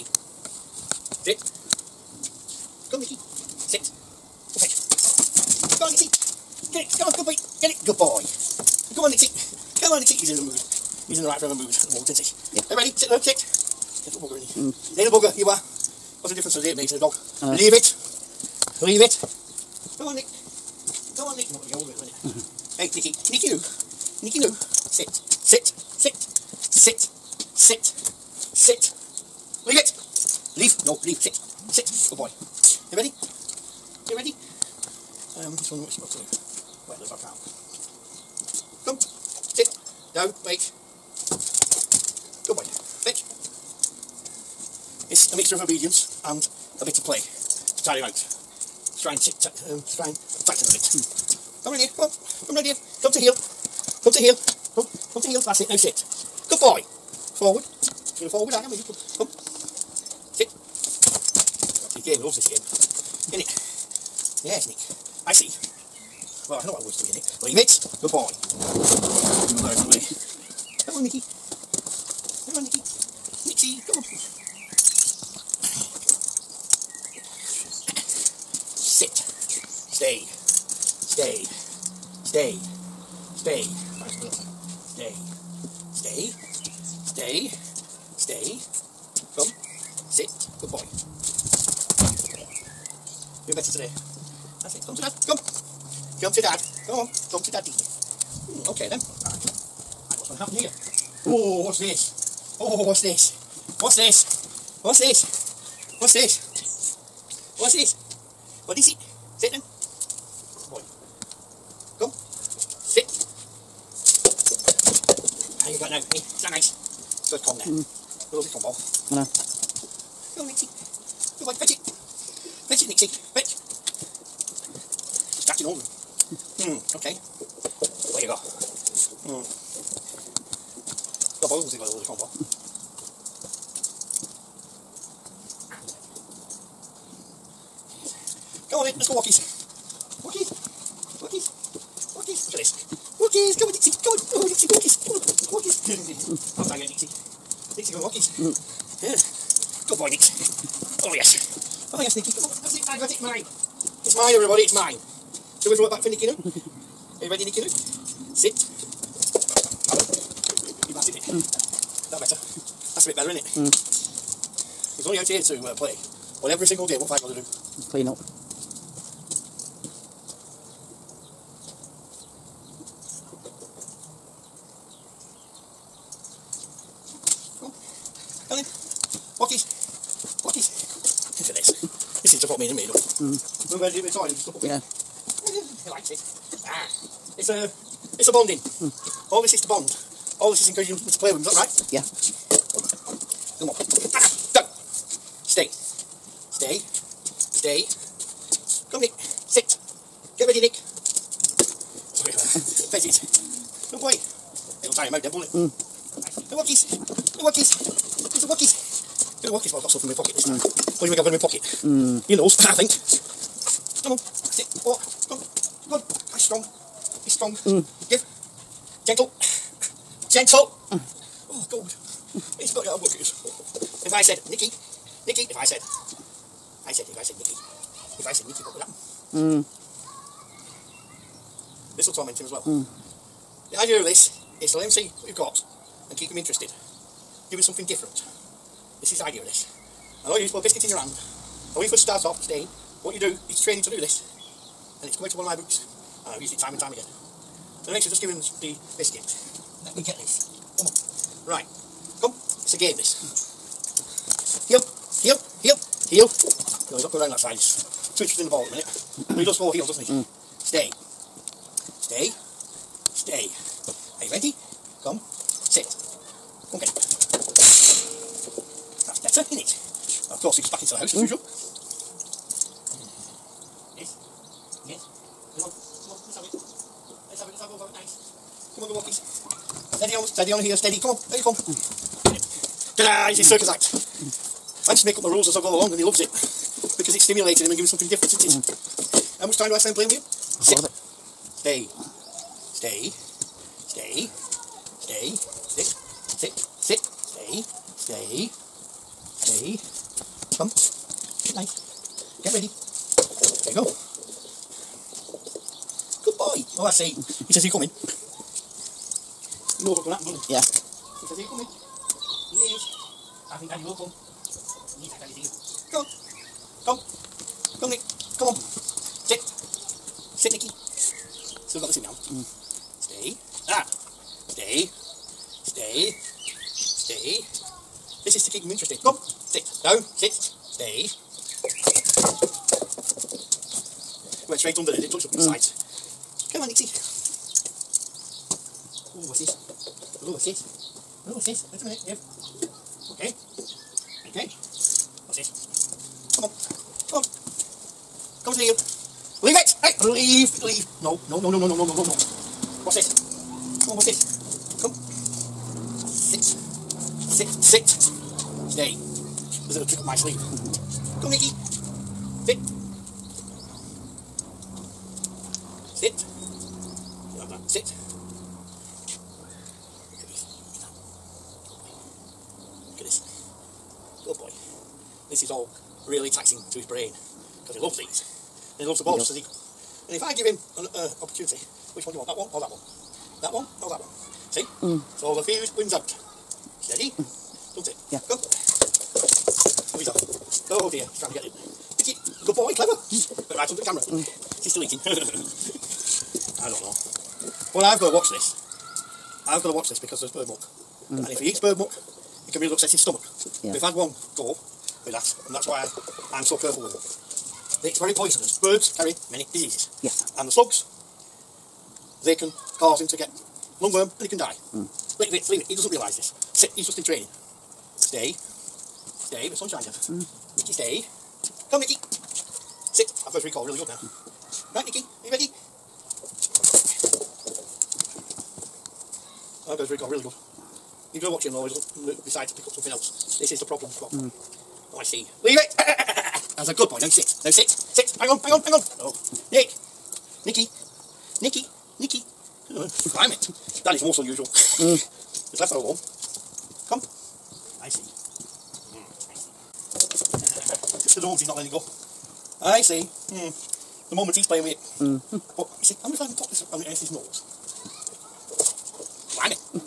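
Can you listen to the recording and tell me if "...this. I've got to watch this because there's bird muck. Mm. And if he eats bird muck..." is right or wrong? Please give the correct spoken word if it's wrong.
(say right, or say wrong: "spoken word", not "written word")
right.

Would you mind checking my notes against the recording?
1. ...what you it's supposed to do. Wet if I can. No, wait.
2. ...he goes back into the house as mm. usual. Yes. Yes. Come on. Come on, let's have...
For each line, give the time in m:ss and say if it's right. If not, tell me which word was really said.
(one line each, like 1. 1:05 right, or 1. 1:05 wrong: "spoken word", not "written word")
1. 0:35 right
2. 4:30 right.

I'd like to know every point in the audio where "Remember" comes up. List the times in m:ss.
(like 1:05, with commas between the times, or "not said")
3:03.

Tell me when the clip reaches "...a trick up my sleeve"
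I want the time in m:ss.
5:59.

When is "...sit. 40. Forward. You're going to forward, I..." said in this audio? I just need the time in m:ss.
0:55.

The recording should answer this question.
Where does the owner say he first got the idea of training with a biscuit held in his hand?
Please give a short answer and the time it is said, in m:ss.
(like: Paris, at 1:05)
One of my books, at 4:05.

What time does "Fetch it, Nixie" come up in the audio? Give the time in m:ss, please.
2:02.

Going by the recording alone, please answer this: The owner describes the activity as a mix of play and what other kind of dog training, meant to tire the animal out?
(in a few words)
Obedience.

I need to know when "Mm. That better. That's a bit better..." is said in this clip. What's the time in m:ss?
2:41.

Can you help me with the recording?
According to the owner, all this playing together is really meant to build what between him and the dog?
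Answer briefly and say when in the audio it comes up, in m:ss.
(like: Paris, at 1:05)
Bonding, at 3:08.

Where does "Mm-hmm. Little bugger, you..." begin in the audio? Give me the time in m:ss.
0:14.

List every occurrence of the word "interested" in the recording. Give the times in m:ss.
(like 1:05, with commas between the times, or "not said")
3:56, 4:18, 5:28.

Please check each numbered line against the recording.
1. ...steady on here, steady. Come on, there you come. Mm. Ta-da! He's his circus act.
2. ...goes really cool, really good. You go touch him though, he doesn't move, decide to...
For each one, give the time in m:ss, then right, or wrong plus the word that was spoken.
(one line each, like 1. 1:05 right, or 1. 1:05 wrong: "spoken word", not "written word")
1. 4:40 right
2. 7:09 wrong: "watch", not "touch".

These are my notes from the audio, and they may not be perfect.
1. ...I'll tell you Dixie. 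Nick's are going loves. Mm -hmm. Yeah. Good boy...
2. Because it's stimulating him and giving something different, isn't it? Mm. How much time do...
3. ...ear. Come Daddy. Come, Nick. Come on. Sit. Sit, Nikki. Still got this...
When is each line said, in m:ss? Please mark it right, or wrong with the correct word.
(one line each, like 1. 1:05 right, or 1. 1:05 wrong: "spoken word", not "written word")
1. 2:26 wrong: "walkies", not "loves"
2. 4:46 right
3. 5:15 wrong: "Come", not "Daddy".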